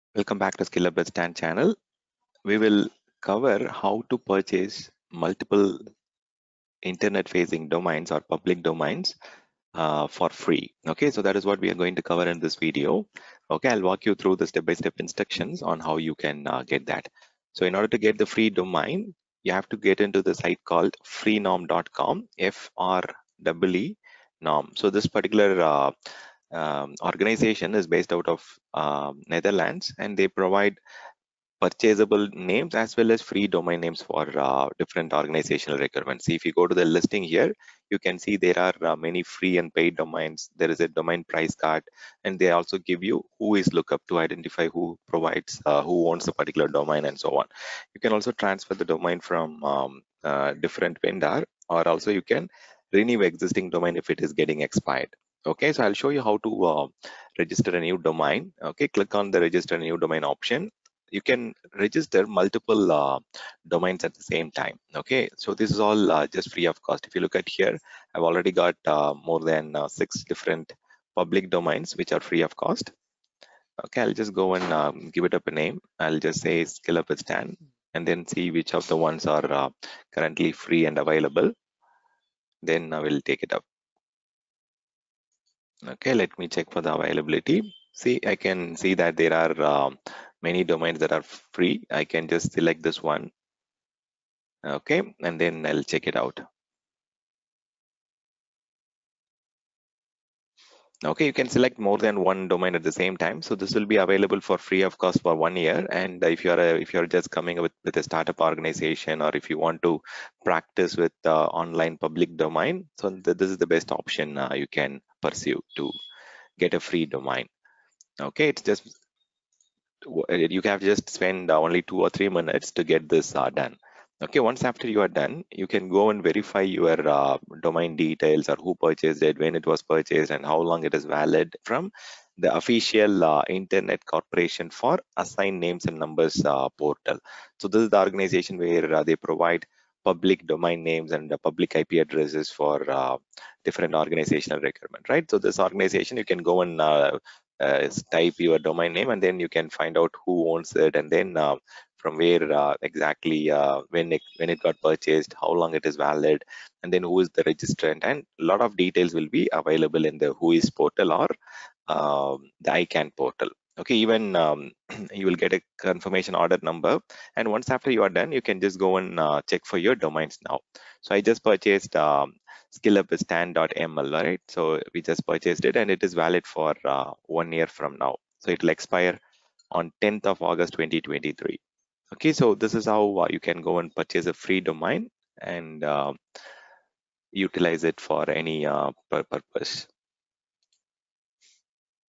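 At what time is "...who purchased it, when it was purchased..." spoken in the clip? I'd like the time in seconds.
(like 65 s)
128 s.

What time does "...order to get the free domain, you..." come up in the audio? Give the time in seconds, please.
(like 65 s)
17 s.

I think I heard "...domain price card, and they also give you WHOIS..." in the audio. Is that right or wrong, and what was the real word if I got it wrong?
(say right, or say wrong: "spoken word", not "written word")
right.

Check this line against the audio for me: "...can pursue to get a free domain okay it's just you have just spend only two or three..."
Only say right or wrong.
right.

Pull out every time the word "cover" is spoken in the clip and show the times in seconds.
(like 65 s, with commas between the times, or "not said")
3 s, 12 s.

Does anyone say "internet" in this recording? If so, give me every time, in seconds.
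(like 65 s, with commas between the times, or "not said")
6 s, 133 s.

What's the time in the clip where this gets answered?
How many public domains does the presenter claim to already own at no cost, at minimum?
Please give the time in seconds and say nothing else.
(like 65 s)
69 s.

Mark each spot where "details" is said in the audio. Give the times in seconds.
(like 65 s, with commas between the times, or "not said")
127 s, 158 s.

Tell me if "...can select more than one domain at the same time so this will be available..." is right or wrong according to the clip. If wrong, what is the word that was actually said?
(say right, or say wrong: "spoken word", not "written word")
right.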